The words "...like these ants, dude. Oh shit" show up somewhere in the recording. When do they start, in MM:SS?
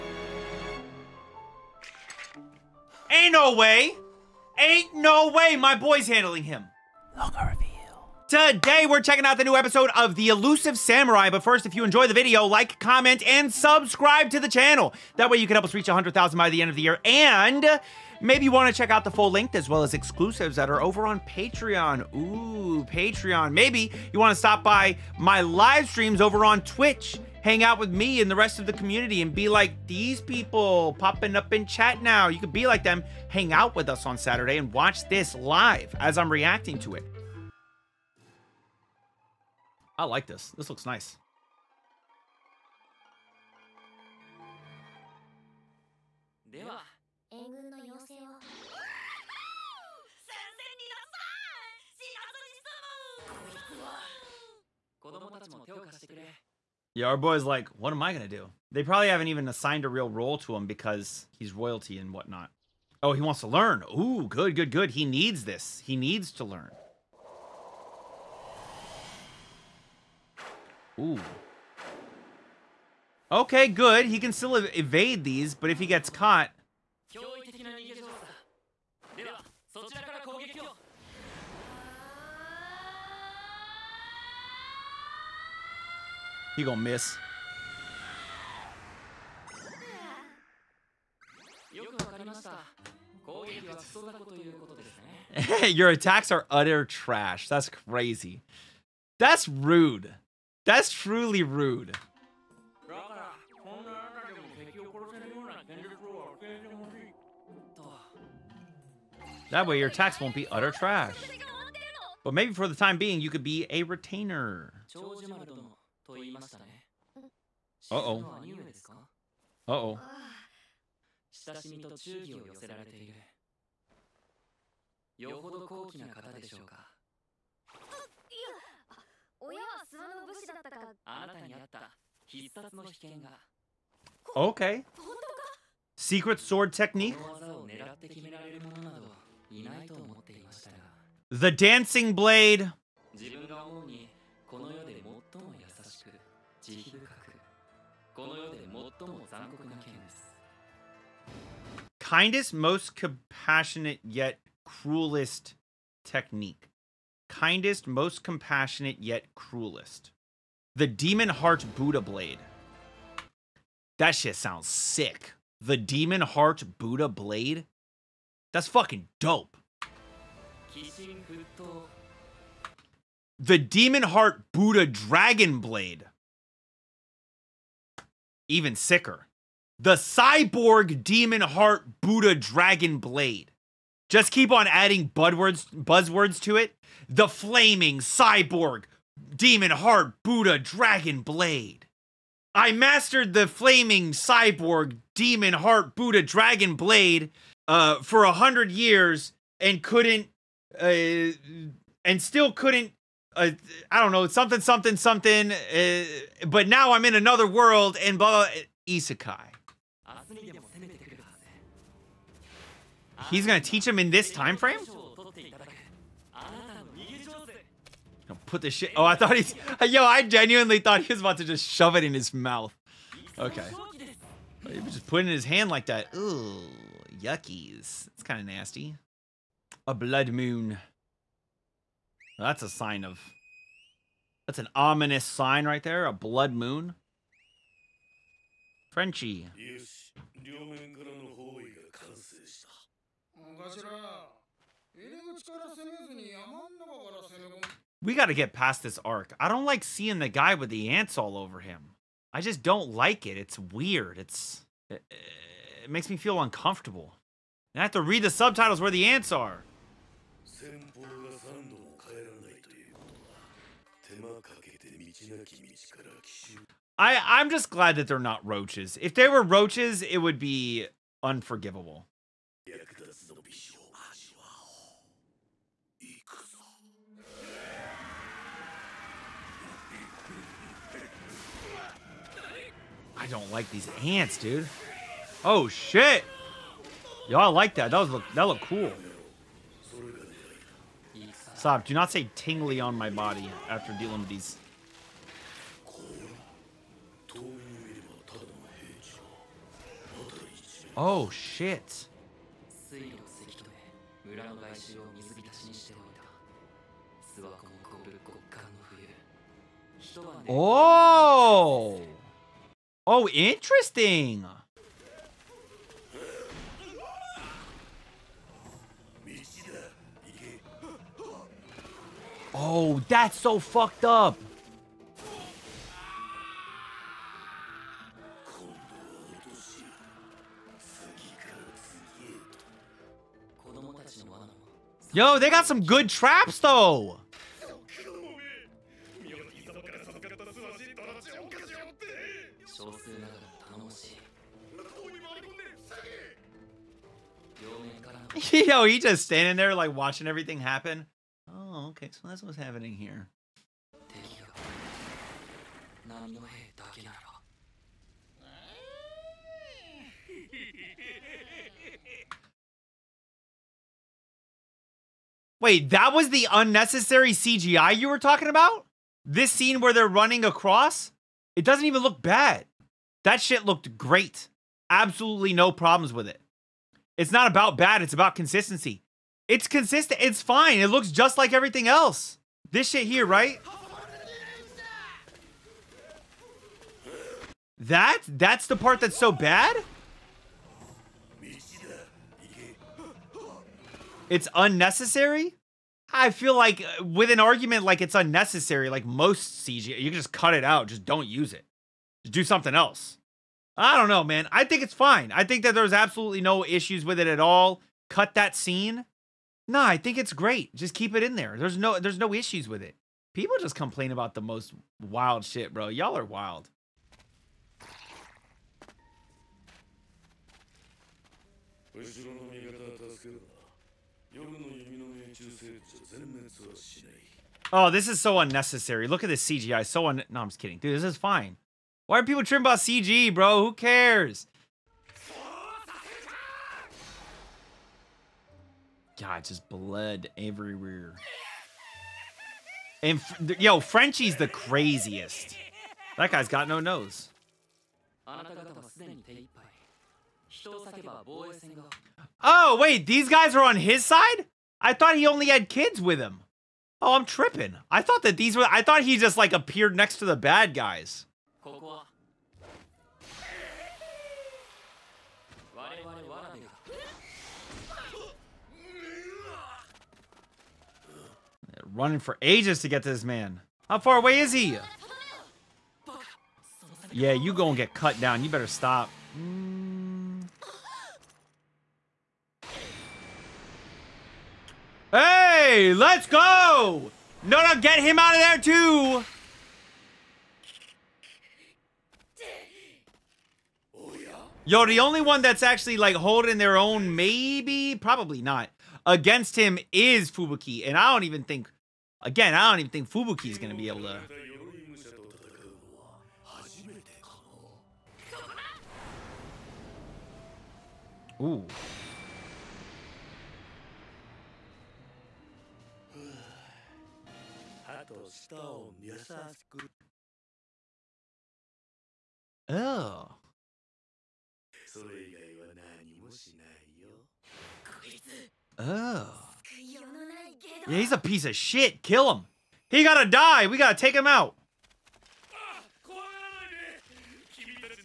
04:43.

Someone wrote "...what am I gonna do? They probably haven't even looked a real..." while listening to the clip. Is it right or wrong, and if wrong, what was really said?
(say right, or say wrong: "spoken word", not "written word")
wrong: "assigned", not "looked".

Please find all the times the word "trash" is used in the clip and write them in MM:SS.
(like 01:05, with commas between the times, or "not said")
01:36, 01:50.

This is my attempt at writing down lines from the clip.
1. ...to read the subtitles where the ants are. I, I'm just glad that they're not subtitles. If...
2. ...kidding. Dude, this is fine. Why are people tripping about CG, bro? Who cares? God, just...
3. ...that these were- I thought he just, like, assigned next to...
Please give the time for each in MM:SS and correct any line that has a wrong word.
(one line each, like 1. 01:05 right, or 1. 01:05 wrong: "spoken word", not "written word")
1. 04:17 wrong: "roaches", not "subtitles"
2. 07:10 right
3. 07:38 wrong: "appeared", not "assigned".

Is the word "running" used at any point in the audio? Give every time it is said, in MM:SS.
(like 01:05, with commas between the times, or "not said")
06:10, 07:51.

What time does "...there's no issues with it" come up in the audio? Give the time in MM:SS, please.
06:51.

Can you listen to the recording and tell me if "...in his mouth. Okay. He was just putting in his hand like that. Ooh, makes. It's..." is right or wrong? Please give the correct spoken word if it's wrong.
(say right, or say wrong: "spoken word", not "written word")
wrong: "yuckies", not "makes".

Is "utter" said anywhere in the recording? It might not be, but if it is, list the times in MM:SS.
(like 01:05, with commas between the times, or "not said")
01:36, 01:50.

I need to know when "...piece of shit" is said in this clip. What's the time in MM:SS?
08:51.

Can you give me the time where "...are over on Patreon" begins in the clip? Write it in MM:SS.
00:20.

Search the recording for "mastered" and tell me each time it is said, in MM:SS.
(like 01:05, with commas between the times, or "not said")
03:12.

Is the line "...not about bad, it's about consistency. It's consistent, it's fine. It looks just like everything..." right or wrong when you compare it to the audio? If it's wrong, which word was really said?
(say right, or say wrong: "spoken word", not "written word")
right.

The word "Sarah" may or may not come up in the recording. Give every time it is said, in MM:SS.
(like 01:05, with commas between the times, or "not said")
not said.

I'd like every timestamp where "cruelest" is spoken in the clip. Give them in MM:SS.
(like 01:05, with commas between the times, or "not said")
02:34, 02:39.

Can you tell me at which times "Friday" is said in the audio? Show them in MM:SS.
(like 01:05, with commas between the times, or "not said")
not said.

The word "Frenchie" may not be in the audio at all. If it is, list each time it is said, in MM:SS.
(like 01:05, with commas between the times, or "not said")
03:58, 07:23.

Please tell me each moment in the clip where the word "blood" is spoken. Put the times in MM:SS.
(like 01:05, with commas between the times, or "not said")
03:49, 03:56.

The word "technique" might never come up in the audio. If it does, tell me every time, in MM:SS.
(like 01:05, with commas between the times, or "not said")
02:16, 02:36.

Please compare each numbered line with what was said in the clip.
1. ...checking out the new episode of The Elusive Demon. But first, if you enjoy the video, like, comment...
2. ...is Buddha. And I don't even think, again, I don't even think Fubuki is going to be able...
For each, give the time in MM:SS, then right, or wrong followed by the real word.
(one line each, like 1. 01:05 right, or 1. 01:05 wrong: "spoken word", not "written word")
1. 00:09 wrong: "Samurai", not "Demon"
2. 08:19 wrong: "Fubuki", not "Buddha".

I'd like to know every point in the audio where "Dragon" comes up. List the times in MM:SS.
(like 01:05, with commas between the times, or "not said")
02:54, 03:02, 03:10, 03:16.